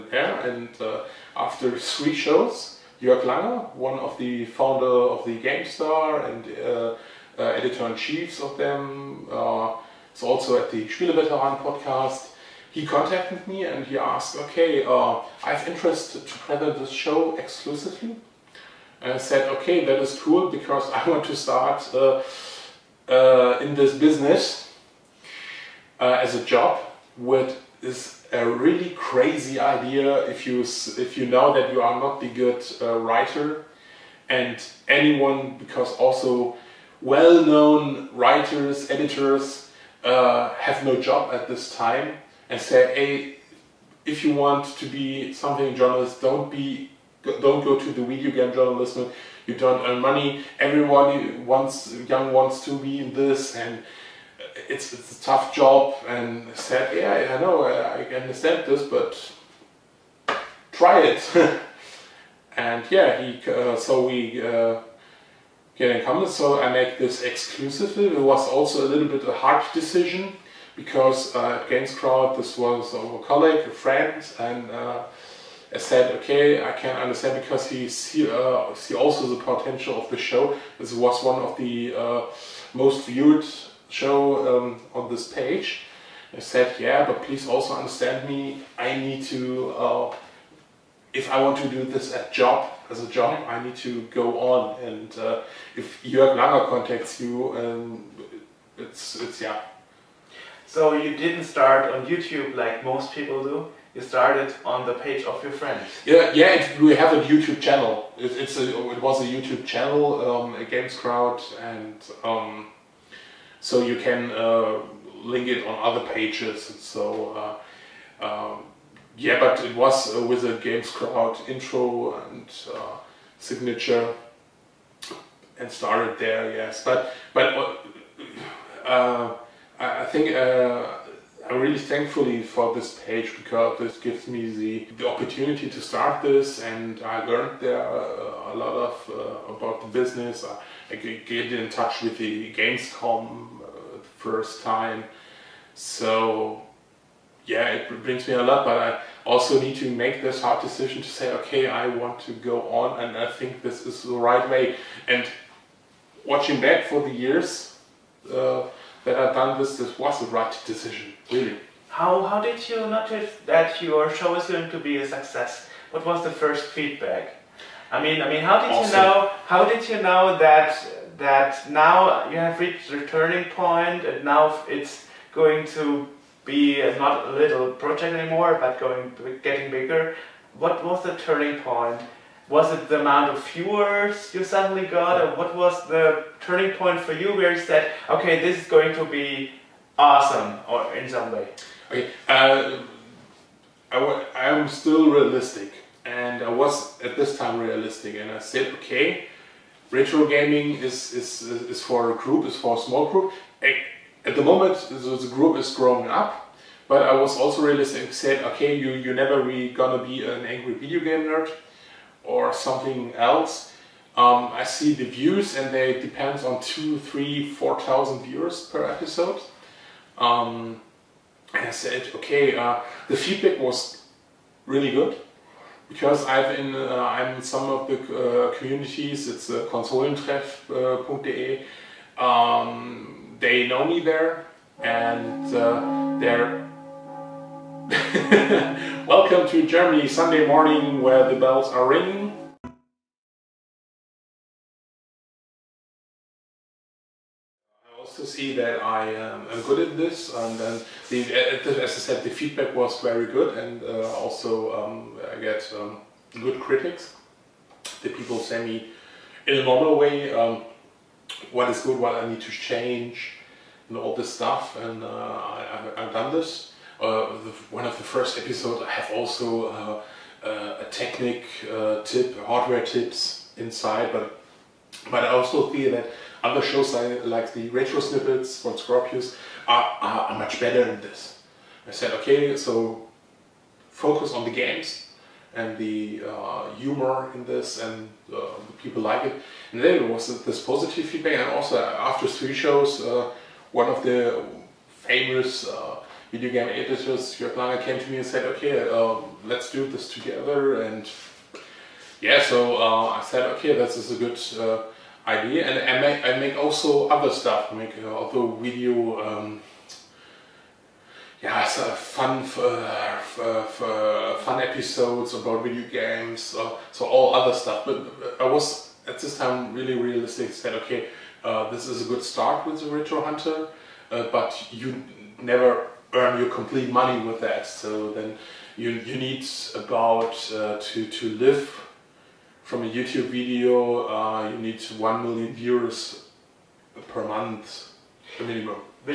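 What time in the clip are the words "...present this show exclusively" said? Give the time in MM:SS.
00:16.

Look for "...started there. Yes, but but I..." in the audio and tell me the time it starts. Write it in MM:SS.
02:05.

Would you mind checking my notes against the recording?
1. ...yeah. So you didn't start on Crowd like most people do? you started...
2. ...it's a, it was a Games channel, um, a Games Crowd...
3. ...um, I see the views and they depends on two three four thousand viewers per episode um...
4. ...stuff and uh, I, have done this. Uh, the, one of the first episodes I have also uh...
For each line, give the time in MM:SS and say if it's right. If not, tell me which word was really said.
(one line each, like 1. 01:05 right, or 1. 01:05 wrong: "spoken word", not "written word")
1. 01:39 wrong: "YouTube", not "Crowd"
2. 01:48 wrong: "YouTube", not "Games"
3. 03:34 right
4. 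04:24 right.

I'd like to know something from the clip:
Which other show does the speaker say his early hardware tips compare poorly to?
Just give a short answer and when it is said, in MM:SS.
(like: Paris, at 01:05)
Retro Snippets, at 04:37.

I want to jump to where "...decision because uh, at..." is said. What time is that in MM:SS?
01:09.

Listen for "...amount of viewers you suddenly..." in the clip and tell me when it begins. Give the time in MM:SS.
03:03.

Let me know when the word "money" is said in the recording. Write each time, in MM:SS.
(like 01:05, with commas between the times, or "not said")
00:50, 05:26.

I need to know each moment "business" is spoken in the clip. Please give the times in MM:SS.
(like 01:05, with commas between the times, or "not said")
00:23, 02:19.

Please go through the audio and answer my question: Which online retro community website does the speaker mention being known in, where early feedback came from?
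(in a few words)
konsolentreff.de.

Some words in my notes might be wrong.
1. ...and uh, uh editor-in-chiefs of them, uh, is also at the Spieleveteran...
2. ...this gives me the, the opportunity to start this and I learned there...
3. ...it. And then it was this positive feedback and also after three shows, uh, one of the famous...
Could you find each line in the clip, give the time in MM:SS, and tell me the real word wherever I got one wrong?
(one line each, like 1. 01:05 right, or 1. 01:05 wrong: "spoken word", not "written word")
1. 00:06 right
2. 02:13 right
3. 04:49 right.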